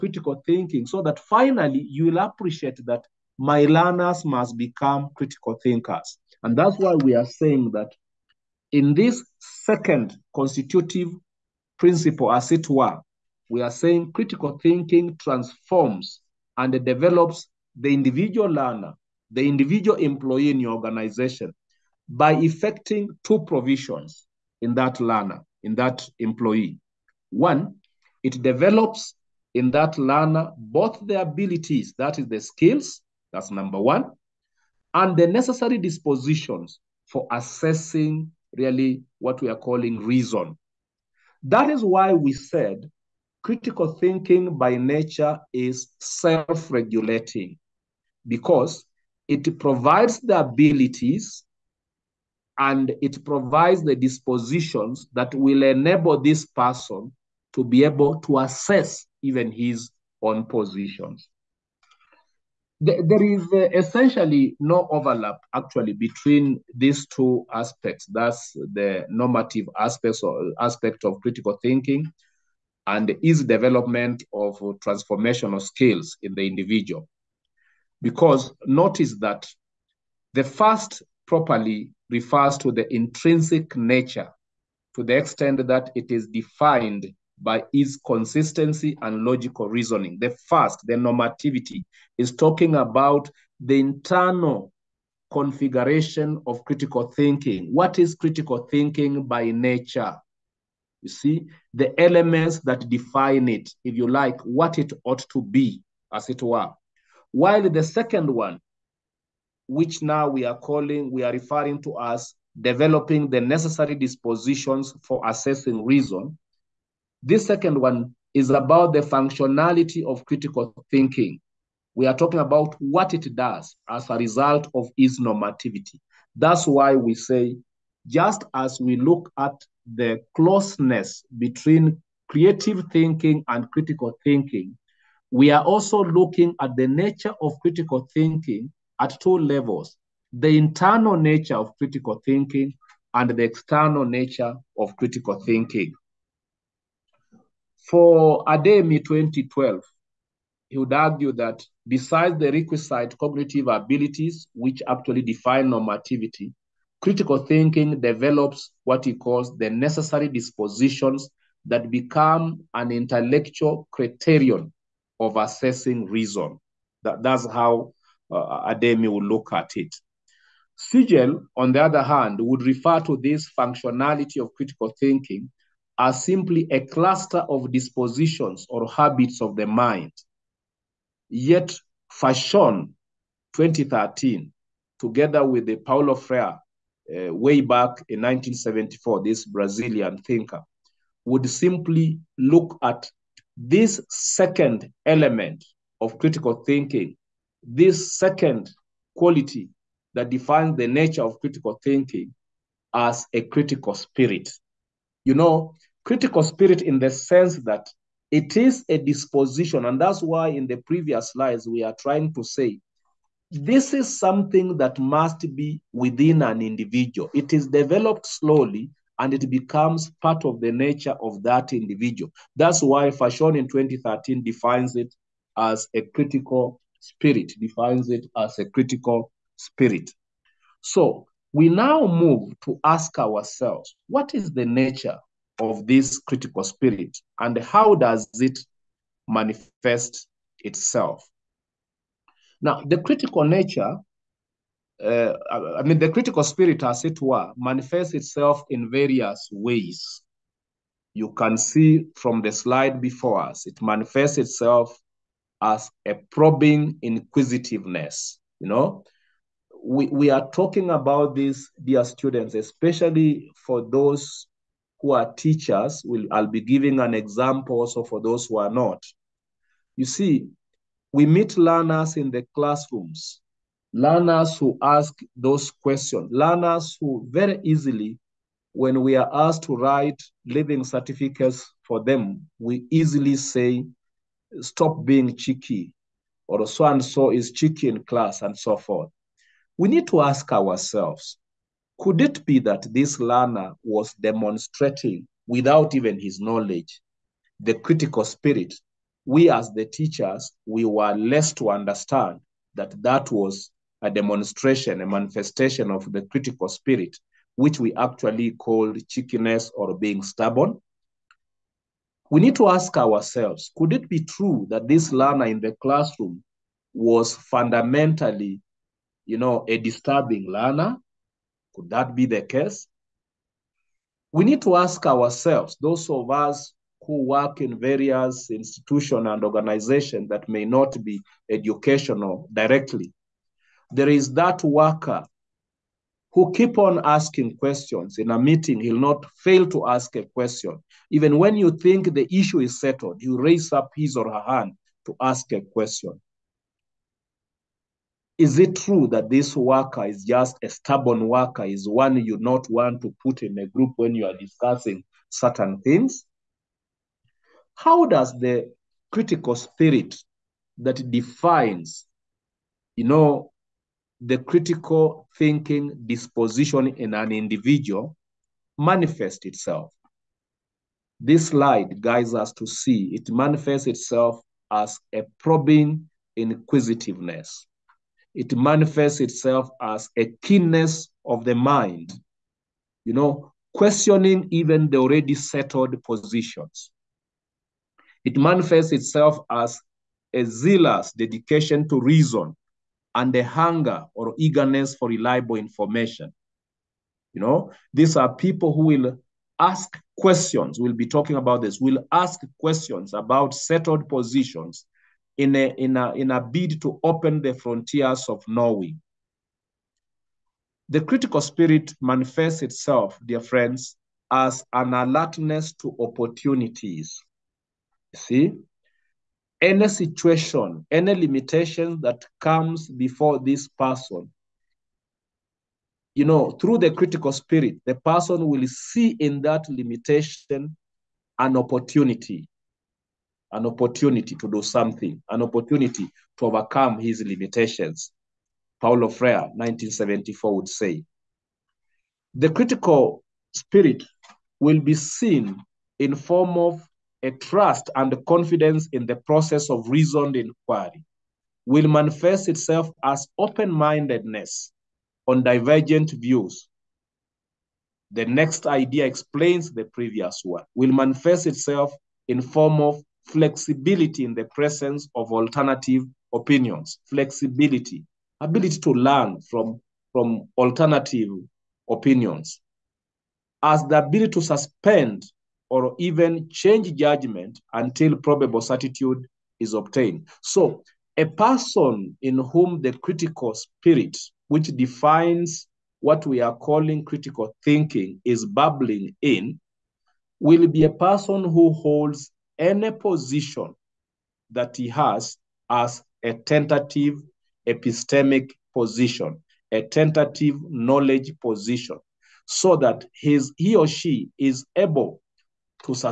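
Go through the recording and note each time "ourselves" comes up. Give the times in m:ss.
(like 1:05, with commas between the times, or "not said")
3:53, 4:50, 5:12, 5:25.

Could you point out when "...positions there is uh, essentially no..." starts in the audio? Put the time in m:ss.
1:00.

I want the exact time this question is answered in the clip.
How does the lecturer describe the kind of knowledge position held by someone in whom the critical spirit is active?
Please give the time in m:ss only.
8:16.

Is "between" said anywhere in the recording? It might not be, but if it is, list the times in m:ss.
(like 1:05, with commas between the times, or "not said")
1:05, 2:11.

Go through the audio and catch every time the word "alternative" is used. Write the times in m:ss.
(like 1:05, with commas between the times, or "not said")
7:45, 7:50.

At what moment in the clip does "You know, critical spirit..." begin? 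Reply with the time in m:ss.
3:25.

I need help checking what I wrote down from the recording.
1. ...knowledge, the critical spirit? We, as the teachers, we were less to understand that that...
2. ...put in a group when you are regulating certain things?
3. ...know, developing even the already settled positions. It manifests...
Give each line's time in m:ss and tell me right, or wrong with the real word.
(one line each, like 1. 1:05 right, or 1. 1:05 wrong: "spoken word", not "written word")
1. 4:56 right
2. 5:53 wrong: "discussing", not "regulating"
3. 6:23 wrong: "questioning", not "developing".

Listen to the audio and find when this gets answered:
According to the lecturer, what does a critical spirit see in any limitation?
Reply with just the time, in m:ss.
6:55.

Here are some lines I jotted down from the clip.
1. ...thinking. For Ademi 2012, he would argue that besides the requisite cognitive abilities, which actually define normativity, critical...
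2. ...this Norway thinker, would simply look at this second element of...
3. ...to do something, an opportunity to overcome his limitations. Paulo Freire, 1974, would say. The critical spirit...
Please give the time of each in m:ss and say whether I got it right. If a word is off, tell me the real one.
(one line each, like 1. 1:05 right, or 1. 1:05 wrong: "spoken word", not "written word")
1. 2:25 right
2. 3:09 wrong: "Brazilian", not "Norway"
3. 7:14 right.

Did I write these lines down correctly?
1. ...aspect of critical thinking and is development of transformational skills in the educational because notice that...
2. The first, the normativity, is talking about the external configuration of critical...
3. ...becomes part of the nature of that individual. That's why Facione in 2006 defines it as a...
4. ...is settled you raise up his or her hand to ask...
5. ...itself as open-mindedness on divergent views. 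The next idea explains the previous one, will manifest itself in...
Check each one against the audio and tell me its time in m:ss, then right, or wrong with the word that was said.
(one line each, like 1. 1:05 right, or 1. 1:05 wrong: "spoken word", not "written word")
1. 1:10 wrong: "individual", not "educational"
2. 1:30 wrong: "internal", not "external"
3. 3:39 wrong: "2013", not "2006"
4. 5:42 right
5. 7:32 right.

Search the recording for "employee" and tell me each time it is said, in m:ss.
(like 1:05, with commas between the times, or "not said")
0:19, 0:26.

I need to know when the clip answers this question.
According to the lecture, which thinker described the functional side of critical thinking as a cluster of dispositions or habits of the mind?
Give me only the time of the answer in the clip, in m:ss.
2:50.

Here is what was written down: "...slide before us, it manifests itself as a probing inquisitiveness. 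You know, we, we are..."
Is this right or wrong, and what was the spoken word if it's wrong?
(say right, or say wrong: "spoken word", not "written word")
right.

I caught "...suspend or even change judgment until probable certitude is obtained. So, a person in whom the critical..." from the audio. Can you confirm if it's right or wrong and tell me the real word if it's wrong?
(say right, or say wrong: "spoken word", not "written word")
right.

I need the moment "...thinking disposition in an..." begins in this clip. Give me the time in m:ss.
6:05.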